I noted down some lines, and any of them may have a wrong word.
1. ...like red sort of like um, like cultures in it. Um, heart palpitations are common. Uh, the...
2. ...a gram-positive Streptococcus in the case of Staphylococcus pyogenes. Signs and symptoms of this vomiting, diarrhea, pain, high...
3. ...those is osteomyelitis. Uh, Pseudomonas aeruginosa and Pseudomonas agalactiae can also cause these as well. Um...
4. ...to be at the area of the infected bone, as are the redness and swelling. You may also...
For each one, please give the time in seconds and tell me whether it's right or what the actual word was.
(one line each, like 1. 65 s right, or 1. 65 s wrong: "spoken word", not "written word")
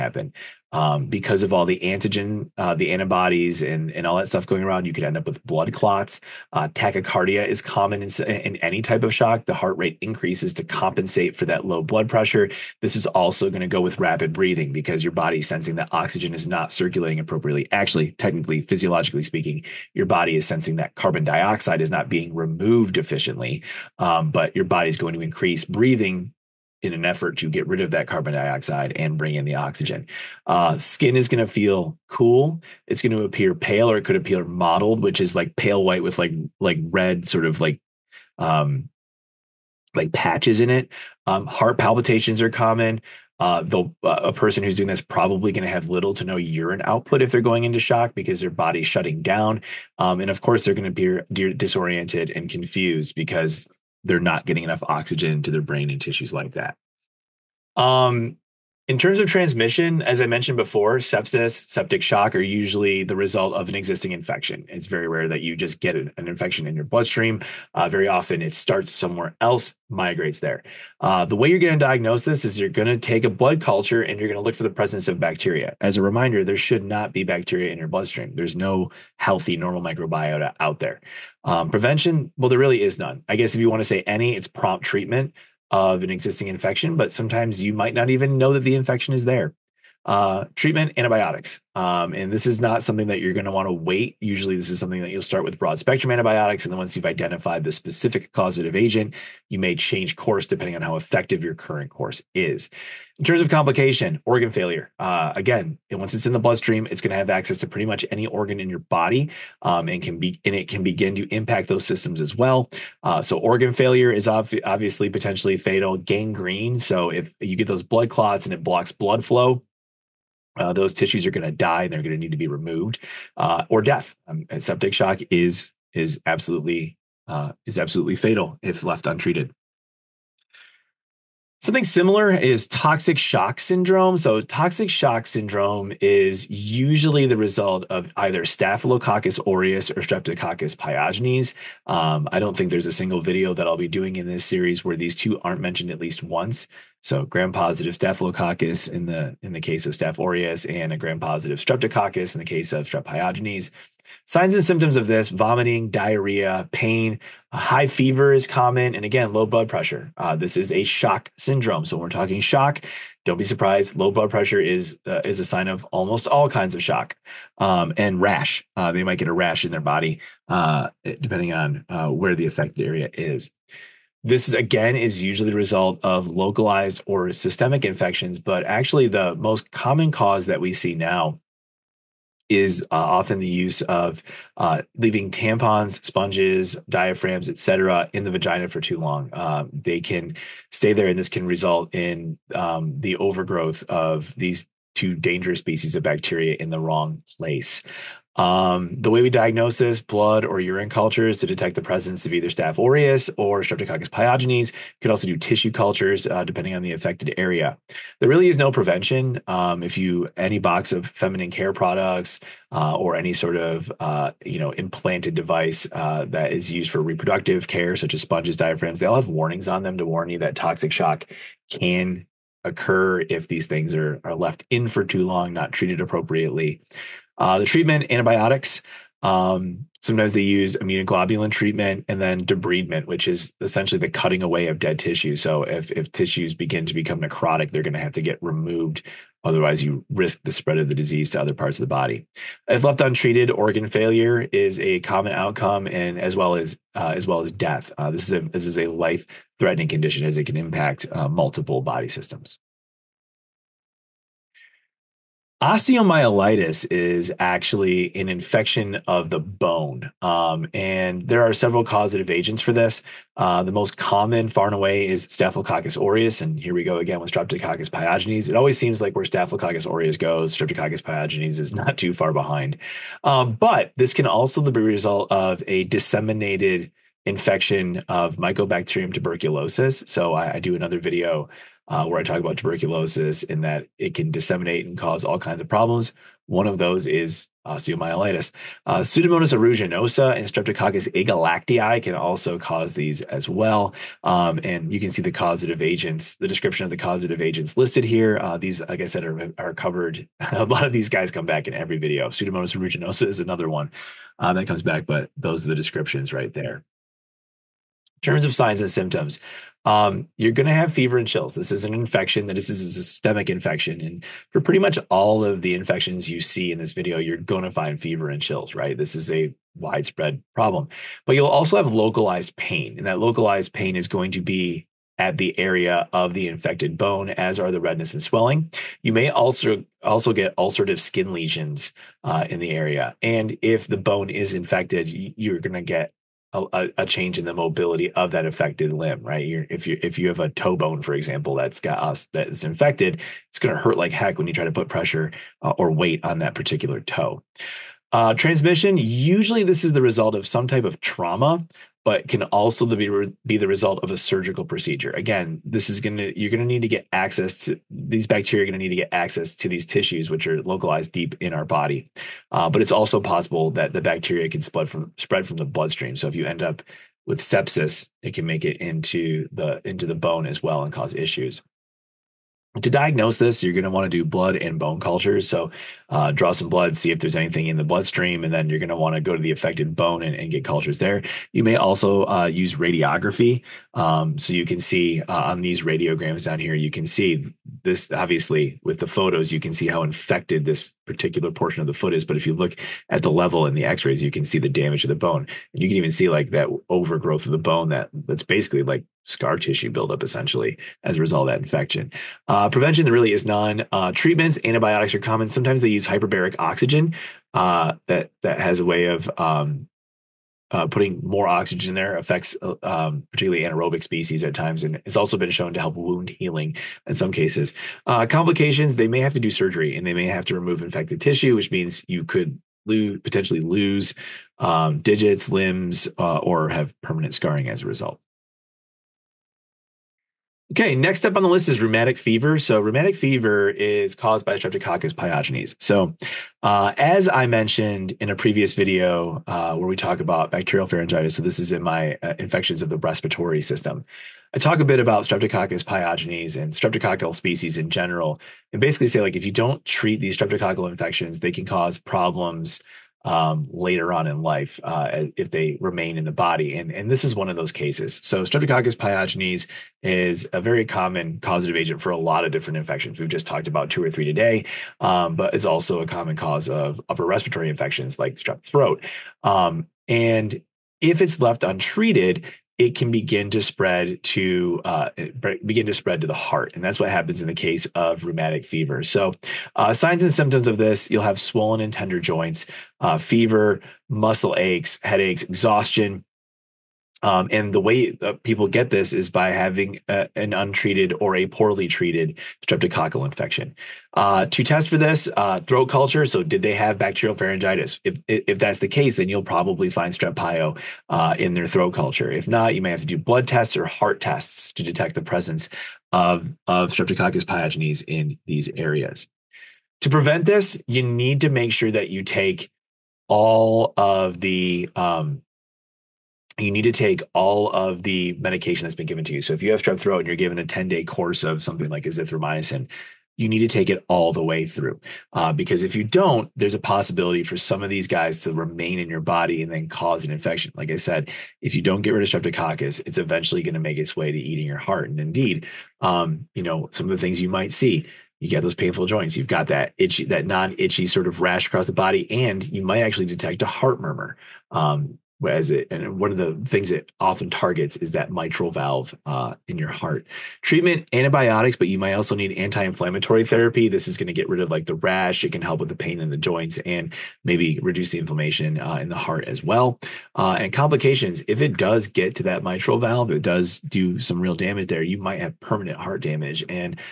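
1. 36 s wrong: "patches", not "cultures"
2. 150 s wrong: "Strep", not "Staphylococcus"
3. 286 s wrong: "Streptococcus", not "Pseudomonas"
4. 324 s right.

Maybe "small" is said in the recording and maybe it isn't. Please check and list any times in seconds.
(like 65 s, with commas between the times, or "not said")
not said.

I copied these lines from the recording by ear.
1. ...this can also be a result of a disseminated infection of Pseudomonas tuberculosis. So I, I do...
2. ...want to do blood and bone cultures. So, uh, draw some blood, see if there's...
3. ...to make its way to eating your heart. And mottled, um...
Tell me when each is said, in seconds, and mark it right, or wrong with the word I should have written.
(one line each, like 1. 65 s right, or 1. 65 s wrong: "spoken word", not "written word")
1. 273 s wrong: "Mycobacterium", not "Pseudomonas"
2. 373 s right
3. 533 s wrong: "indeed", not "mottled".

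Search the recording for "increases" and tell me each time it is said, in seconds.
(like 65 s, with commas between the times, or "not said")
10 s, 25 s.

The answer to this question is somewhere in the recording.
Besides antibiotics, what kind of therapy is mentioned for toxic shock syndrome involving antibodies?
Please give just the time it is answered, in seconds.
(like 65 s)
230 s.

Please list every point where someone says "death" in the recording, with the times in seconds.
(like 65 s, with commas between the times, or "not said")
123 s, 247 s.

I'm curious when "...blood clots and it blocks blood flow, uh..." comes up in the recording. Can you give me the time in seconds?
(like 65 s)
117 s.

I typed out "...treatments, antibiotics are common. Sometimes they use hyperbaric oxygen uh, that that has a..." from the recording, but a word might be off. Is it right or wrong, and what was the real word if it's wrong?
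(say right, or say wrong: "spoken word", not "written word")
right.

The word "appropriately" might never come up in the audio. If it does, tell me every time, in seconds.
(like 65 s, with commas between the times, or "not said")
17 s, 225 s.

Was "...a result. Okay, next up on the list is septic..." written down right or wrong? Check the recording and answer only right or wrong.
wrong.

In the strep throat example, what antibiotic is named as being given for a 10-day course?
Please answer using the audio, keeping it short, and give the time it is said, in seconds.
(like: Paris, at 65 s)
Azithromycin, at 522 s.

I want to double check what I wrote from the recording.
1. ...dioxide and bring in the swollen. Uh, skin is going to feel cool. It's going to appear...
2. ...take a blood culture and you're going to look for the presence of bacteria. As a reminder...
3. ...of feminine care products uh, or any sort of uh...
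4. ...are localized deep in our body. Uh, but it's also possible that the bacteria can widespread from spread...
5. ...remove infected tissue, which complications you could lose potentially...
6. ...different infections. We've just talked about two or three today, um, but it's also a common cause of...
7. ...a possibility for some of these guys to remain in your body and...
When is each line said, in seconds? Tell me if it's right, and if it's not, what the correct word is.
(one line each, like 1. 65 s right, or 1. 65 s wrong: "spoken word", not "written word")
1. 28 s wrong: "oxygen", not "swollen"
2. 72 s right
3. 210 s right
4. 360 s wrong: "spread", not "widespread"
5. 420 s wrong: "means", not "complications"
6. 462 s right
7. 526 s right.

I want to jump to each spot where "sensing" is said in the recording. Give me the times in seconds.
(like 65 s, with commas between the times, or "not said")
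15 s, 20 s.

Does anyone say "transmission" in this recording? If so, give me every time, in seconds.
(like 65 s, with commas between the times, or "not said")
59 s, 348 s.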